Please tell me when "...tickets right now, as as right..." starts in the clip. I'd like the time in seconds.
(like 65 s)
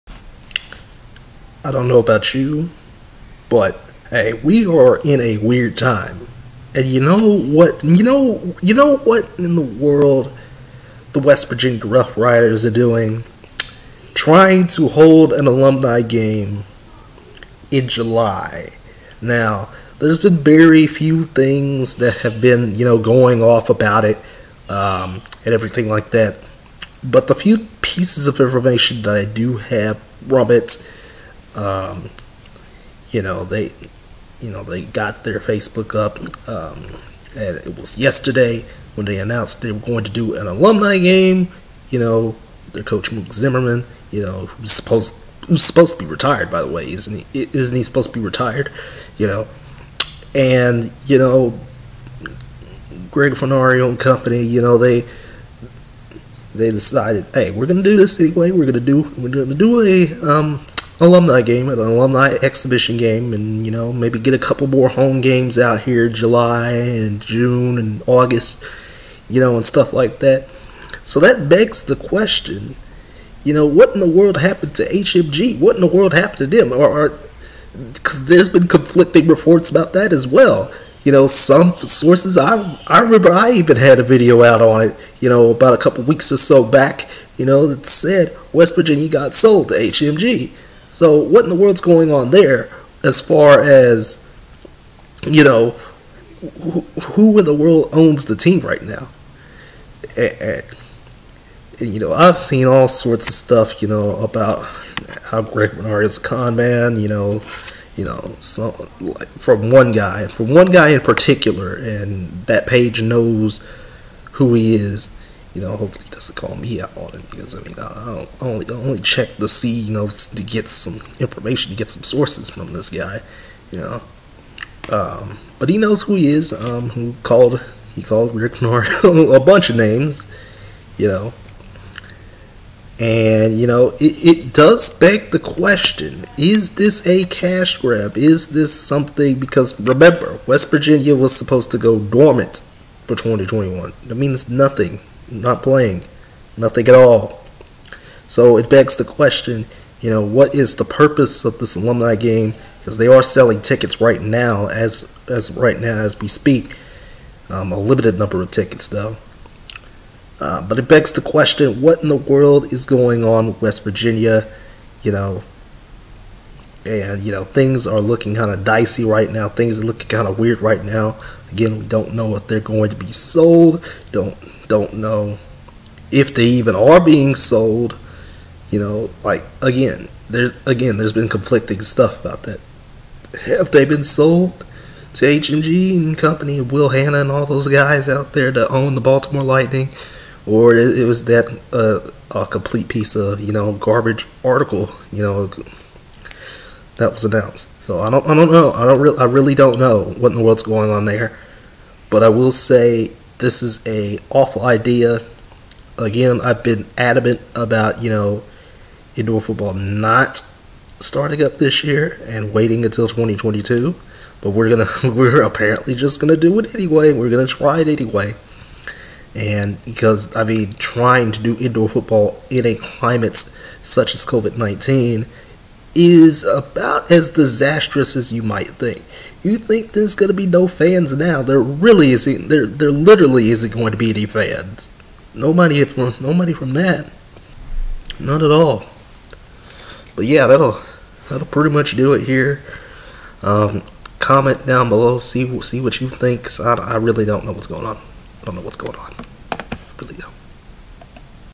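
153 s.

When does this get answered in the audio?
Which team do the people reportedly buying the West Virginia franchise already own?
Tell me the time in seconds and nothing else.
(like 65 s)
189 s.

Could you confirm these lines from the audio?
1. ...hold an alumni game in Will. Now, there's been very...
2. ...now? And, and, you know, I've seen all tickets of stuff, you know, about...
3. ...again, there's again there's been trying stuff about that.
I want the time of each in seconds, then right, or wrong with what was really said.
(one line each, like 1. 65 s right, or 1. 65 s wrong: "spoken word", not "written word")
1. 14 s wrong: "July", not "Will"
2. 98 s wrong: "sorts", not "tickets"
3. 179 s wrong: "conflicting", not "trying".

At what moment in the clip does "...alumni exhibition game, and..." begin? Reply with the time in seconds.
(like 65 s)
61 s.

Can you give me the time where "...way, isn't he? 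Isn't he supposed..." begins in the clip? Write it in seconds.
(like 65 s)
46 s.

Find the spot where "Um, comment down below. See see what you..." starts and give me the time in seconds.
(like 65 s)
243 s.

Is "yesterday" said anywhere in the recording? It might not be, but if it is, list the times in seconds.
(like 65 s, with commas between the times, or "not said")
37 s.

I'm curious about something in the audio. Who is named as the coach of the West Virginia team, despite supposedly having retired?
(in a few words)
Mook Zimmerman.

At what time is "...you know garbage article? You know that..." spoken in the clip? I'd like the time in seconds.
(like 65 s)
193 s.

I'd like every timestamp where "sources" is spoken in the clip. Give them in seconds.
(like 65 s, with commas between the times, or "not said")
81 s, 122 s.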